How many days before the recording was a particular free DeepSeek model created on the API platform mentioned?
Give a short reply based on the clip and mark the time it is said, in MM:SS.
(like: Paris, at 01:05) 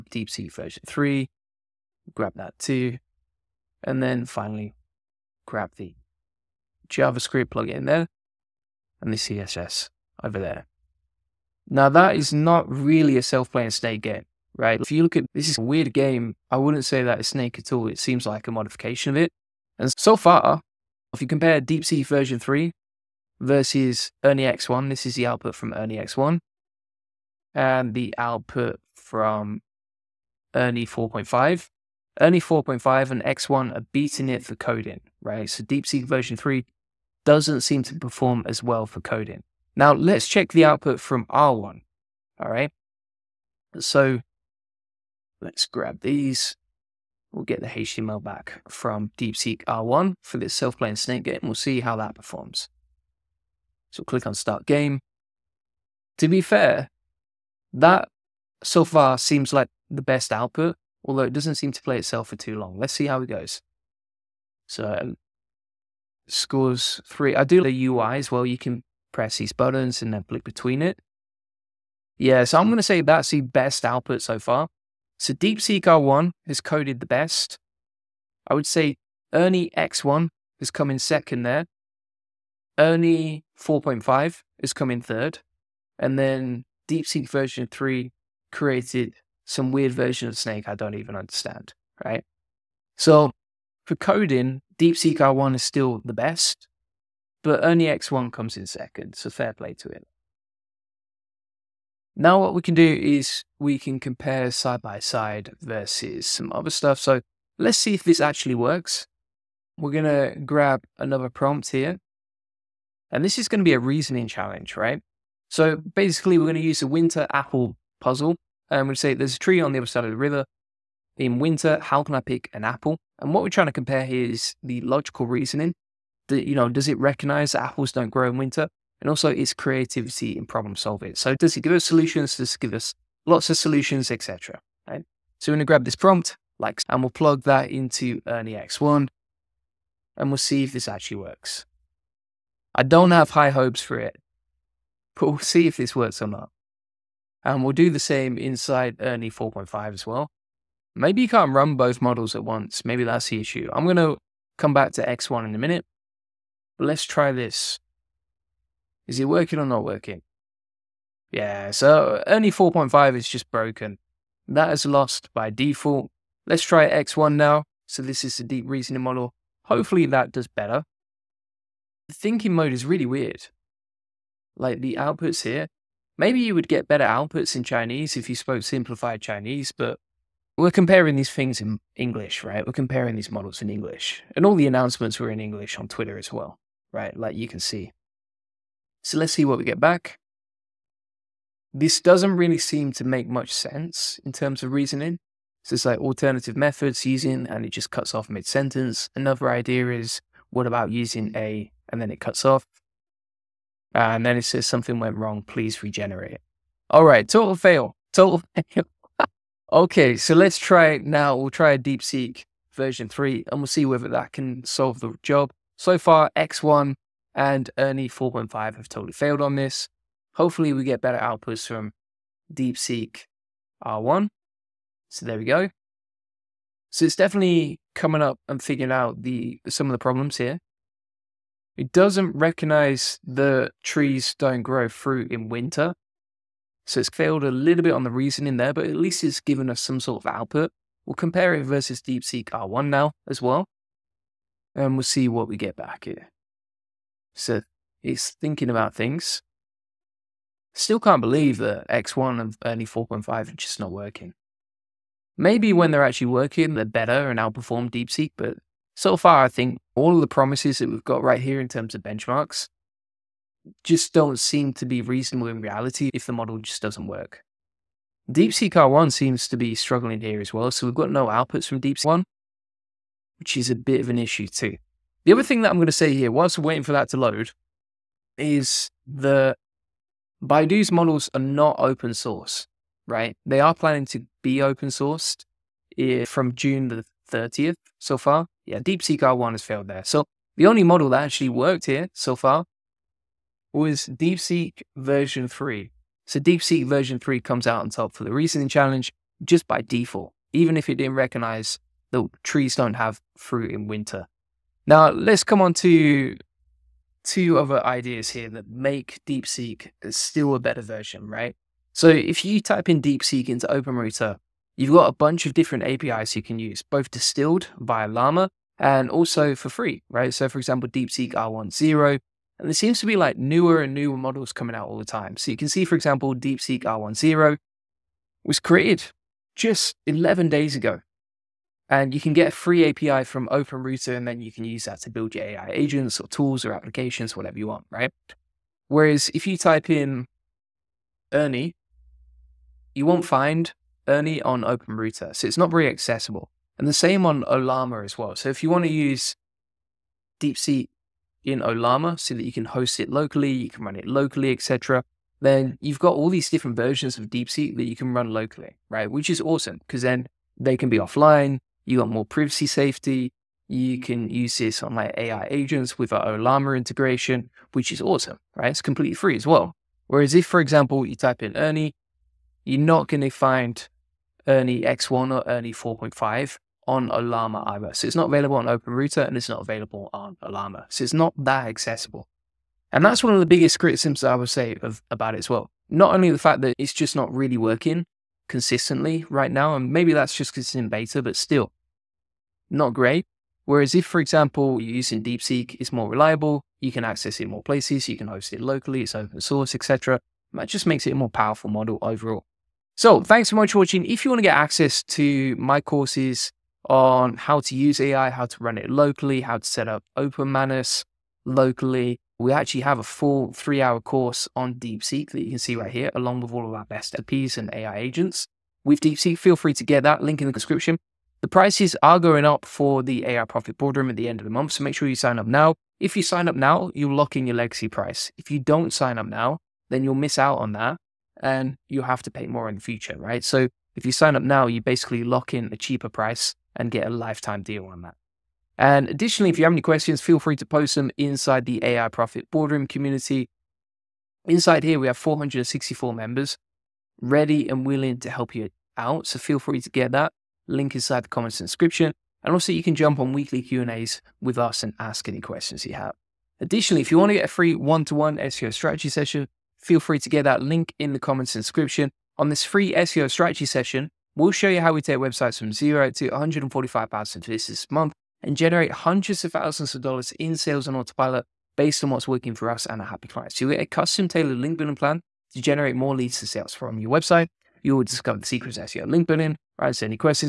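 11, at 05:30.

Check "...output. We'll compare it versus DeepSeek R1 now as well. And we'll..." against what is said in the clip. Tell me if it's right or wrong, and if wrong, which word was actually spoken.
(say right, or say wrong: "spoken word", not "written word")
right.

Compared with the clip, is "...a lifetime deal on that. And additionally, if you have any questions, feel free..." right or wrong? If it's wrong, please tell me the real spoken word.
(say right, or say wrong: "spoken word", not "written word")
right.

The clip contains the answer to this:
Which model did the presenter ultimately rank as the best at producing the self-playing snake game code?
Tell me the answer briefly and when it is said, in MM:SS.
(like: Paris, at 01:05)
DeepSeek R1, at 01:15.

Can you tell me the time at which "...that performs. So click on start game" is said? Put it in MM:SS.
00:51.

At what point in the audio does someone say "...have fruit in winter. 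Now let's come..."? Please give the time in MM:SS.
05:02.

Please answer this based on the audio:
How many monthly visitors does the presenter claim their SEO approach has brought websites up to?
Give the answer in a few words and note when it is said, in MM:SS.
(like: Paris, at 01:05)
145,000, at 07:46.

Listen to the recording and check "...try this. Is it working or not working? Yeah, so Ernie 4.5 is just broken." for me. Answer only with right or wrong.
right.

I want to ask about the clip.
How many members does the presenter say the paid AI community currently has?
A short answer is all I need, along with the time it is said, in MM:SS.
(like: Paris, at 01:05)
464, at 07:25.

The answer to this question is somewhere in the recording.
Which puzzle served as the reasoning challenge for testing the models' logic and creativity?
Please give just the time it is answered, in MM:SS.
01:56.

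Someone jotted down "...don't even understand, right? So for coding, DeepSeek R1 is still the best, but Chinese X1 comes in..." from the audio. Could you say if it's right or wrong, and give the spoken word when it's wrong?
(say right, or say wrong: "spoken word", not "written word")
wrong: "Ernie", not "Chinese".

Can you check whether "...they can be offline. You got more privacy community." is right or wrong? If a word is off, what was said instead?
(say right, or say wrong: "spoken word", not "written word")
wrong: "safety", not "community".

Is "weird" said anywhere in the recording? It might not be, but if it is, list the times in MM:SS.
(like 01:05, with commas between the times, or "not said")
00:15, 01:29, 02:53.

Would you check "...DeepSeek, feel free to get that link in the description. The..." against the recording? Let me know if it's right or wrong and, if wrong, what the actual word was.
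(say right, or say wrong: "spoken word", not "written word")
right.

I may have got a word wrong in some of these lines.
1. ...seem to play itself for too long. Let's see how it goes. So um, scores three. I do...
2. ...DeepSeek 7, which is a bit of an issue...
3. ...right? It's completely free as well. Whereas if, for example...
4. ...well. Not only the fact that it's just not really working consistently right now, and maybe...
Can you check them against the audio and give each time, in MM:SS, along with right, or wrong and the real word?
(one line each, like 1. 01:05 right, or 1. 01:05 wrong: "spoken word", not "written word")
1. 01:01 right
2. 04:31 wrong: "1", not "7"
3. 06:08 right
4. 06:25 right.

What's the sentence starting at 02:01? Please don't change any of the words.
In winter, how can I pick an apple?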